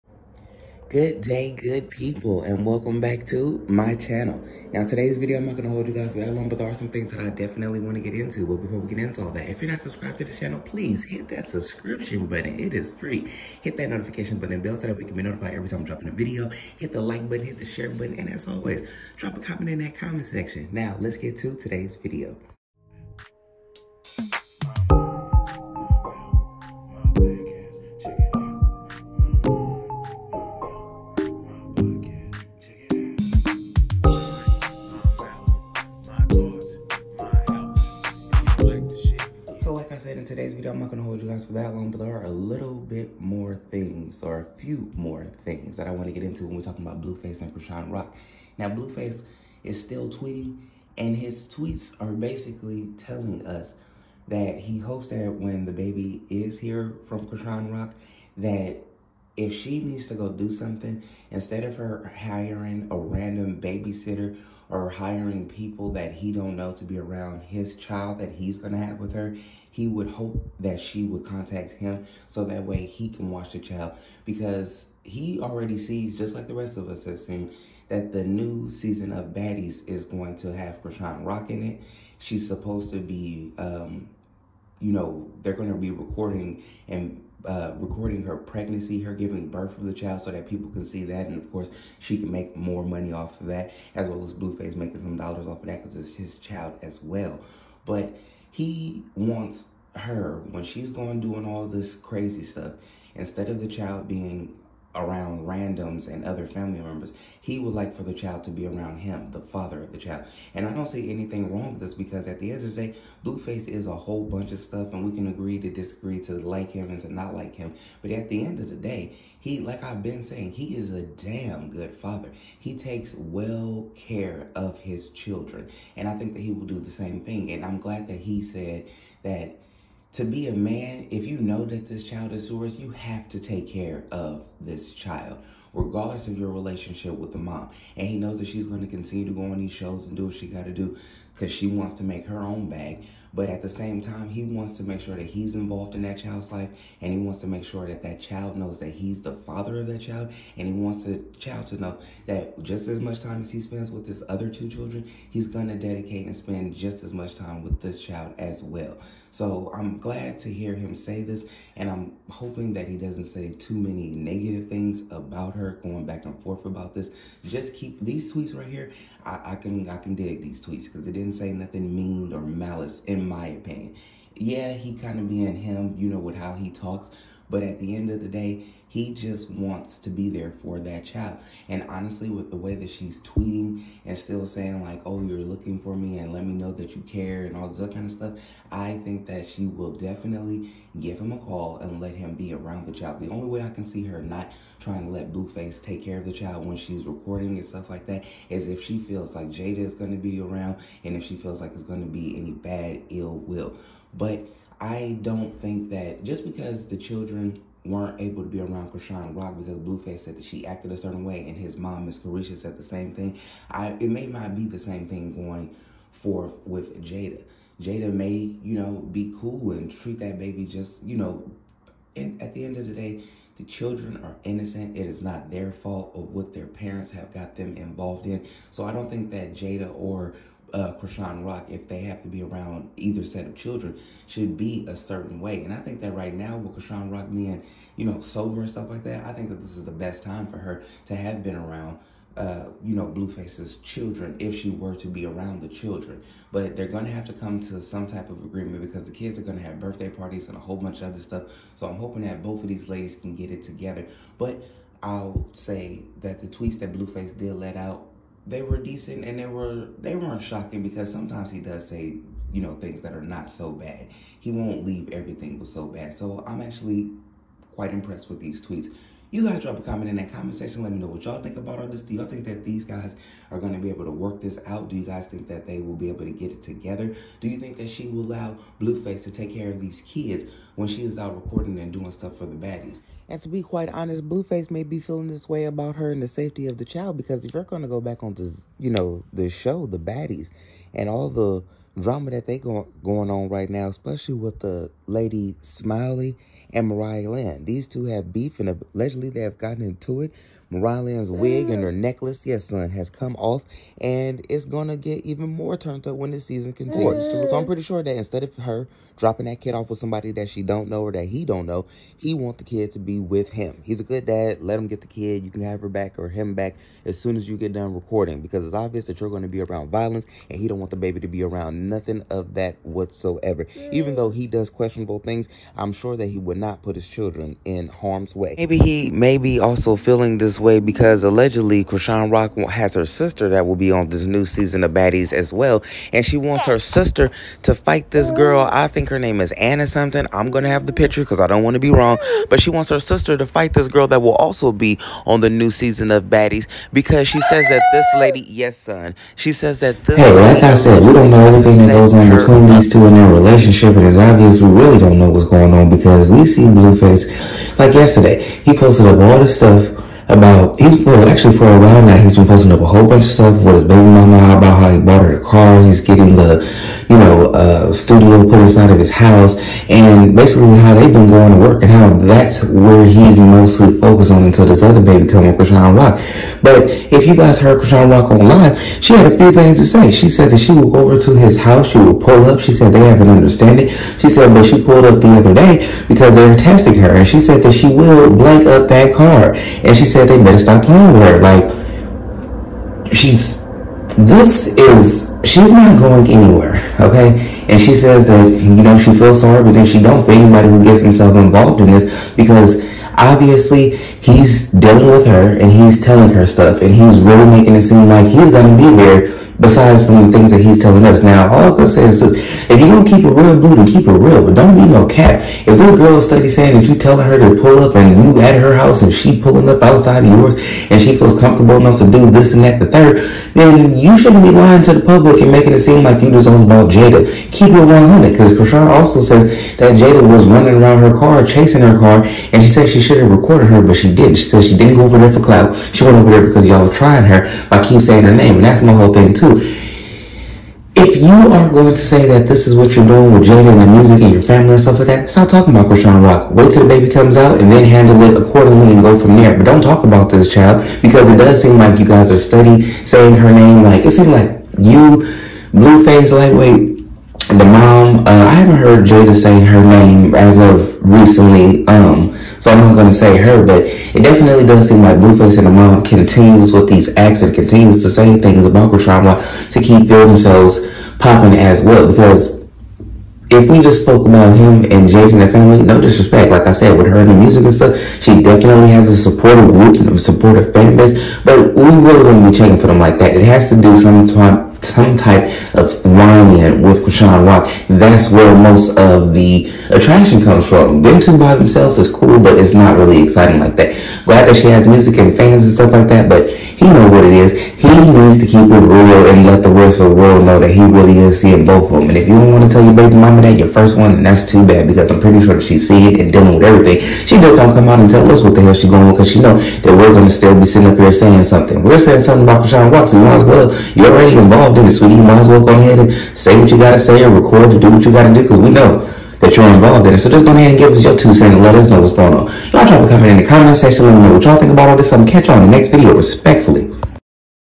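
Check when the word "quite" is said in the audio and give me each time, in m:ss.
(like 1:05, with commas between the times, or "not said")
4:27, 4:43.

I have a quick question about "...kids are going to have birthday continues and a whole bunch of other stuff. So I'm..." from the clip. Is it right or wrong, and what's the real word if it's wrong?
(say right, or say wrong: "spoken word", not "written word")
wrong: "parties", not "continues".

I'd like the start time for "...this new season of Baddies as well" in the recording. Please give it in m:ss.
5:34.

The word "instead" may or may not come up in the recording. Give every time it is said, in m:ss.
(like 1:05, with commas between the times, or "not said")
1:01, 1:43, 5:08.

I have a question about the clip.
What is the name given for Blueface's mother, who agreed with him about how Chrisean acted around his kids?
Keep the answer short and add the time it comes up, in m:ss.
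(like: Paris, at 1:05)
Miss Carisha, at 3:32.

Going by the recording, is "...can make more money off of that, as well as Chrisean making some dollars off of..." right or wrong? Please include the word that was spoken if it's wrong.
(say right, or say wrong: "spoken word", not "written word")
wrong: "Blueface", not "Chrisean".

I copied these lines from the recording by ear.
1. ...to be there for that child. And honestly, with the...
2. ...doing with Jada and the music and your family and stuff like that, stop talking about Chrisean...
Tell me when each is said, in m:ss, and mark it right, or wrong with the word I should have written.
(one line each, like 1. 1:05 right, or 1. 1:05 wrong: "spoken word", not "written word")
1. 2:59 right
2. 7:23 right.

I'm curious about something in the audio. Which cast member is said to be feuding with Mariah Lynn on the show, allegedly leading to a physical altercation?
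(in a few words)
Smiley.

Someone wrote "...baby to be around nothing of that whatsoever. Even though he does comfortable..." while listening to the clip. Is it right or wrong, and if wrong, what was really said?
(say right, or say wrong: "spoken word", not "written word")
wrong: "questionable", not "comfortable".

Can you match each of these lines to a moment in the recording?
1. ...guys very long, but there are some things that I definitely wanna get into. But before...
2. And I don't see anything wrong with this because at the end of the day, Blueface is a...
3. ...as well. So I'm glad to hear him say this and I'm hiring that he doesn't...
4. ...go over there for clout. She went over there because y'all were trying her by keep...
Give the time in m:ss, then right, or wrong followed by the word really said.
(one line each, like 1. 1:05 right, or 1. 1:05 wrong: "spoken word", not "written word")
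1. 0:05 right
2. 1:50 right
3. 2:38 wrong: "hoping", not "hiring"
4. 7:14 right.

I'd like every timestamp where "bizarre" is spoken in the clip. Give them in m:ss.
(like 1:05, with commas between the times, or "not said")
not said.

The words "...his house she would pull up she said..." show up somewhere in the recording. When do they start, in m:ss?
6:21.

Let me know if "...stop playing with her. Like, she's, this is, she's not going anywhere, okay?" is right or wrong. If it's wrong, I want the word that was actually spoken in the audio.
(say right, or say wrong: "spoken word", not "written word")
right.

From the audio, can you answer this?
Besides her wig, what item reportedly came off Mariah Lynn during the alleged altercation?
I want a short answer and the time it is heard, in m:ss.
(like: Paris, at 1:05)
Her necklace, at 5:01.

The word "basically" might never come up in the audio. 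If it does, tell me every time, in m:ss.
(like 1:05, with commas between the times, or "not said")
0:52, 6:10.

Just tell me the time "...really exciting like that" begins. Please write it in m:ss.
8:12.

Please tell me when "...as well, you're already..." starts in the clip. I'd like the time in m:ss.
8:33.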